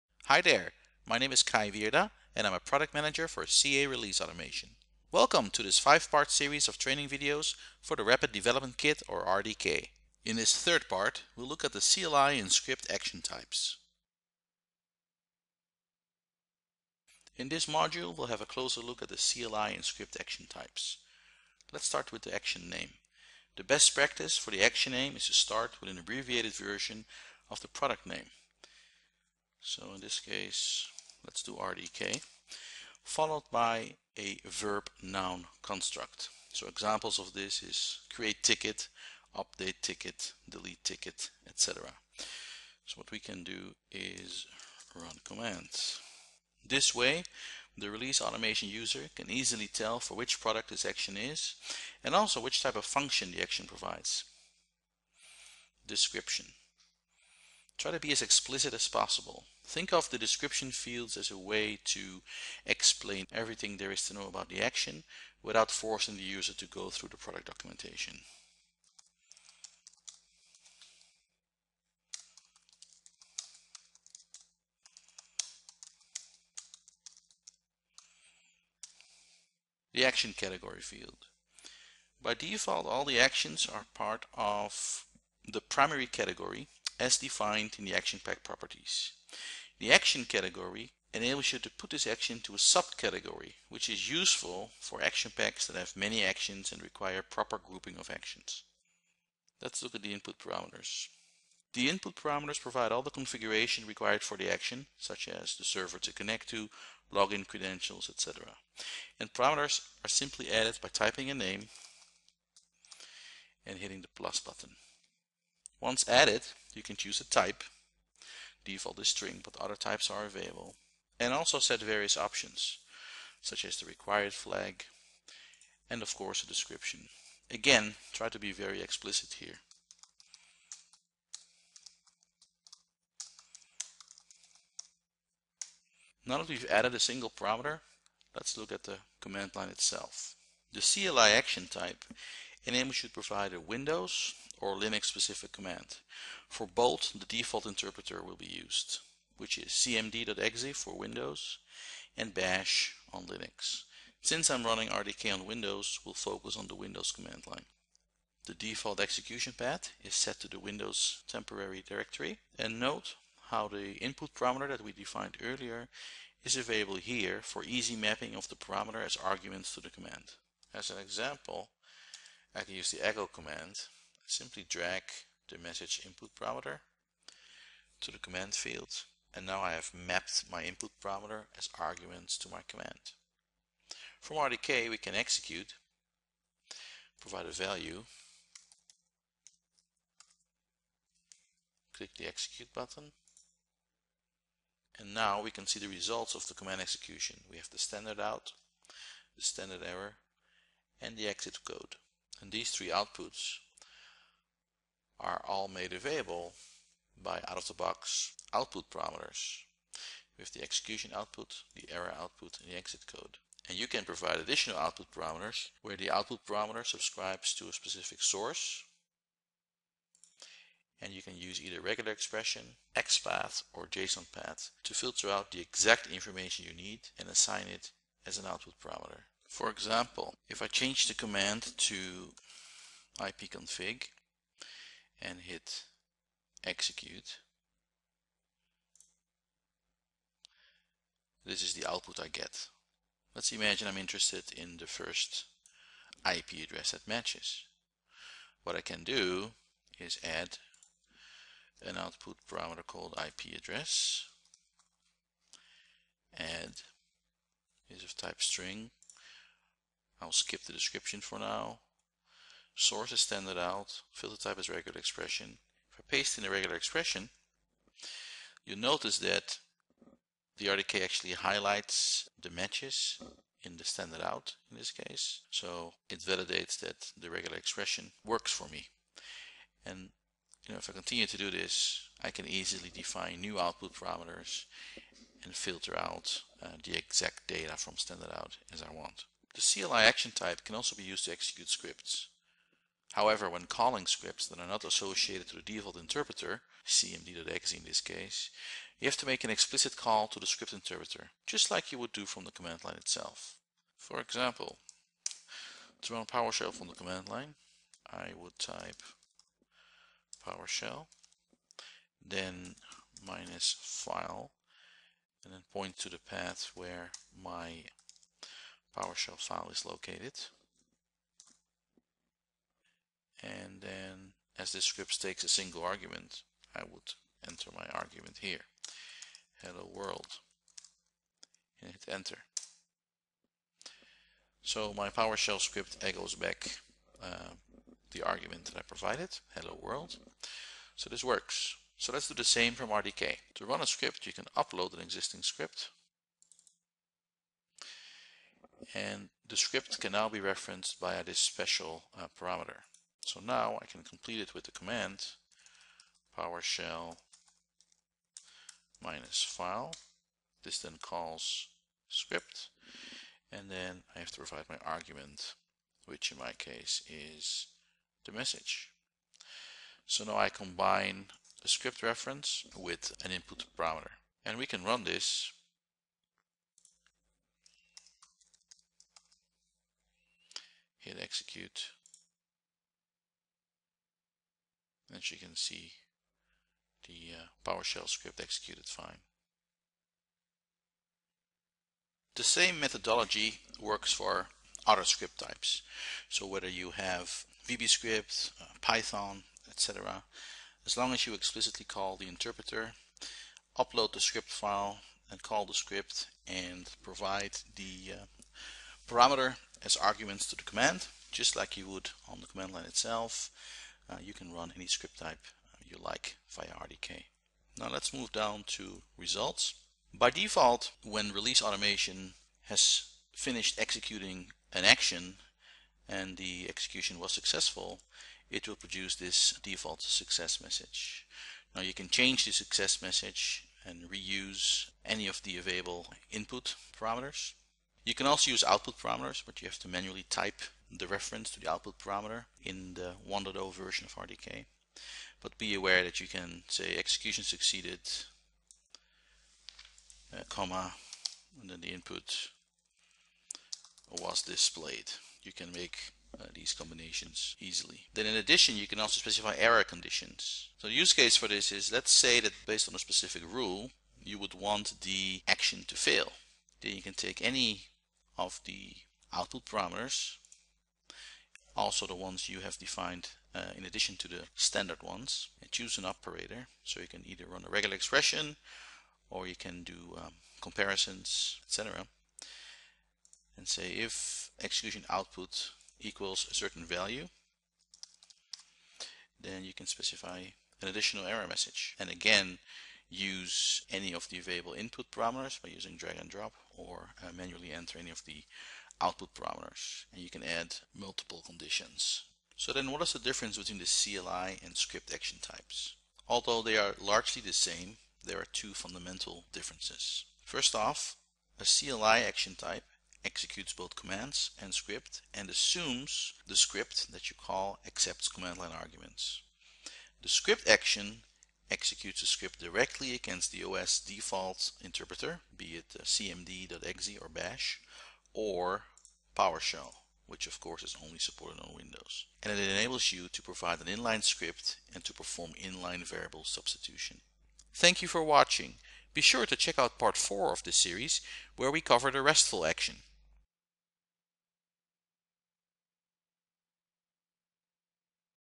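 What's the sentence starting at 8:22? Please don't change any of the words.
So then what is the difference between the CLI and script action types?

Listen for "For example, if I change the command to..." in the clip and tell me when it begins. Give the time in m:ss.
3:49.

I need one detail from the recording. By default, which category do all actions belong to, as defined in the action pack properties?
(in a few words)
primary category.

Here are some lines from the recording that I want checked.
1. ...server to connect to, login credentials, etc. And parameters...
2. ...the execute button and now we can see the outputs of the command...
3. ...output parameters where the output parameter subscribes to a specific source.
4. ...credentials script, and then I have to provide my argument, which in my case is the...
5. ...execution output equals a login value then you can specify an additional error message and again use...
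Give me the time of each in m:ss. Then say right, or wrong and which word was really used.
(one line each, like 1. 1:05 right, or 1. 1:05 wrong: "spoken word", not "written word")
1. 1:45 right
2. 3:12 wrong: "results", not "outputs"
3. 3:34 right
4. 6:01 wrong: "calls", not "credentials"
5. 8:04 wrong: "certain", not "login".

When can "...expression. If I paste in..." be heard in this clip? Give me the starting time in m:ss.
4:24.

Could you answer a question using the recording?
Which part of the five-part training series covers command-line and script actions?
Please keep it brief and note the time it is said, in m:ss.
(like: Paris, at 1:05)
third, at 0:10.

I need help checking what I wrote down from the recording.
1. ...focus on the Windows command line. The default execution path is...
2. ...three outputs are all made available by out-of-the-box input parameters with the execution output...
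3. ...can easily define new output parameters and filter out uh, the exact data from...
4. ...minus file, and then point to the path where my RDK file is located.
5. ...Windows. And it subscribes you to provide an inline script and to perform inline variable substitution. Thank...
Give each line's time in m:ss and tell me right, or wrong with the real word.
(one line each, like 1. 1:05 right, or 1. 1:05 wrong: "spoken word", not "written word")
1. 2:36 right
2. 3:22 wrong: "output", not "input"
3. 4:42 right
4. 5:13 wrong: "PowerShell", not "RDK"
5. 8:51 wrong: "enables", not "subscribes".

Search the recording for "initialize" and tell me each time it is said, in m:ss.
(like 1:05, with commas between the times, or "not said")
not said.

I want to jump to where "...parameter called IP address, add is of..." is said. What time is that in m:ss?
4:12.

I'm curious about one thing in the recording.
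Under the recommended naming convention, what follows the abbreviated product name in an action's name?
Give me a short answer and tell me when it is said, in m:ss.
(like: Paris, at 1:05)
verb noun construct, at 0:34.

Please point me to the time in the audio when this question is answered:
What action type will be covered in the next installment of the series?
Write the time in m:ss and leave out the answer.
9:02.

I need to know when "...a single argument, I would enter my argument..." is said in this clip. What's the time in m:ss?
5:25.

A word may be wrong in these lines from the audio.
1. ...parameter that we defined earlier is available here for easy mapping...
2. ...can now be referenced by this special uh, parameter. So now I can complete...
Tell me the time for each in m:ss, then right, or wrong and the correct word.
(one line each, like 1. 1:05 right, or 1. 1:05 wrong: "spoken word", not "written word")
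1. 2:44 right
2. 5:49 right.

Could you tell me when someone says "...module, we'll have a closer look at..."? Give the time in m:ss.
0:17.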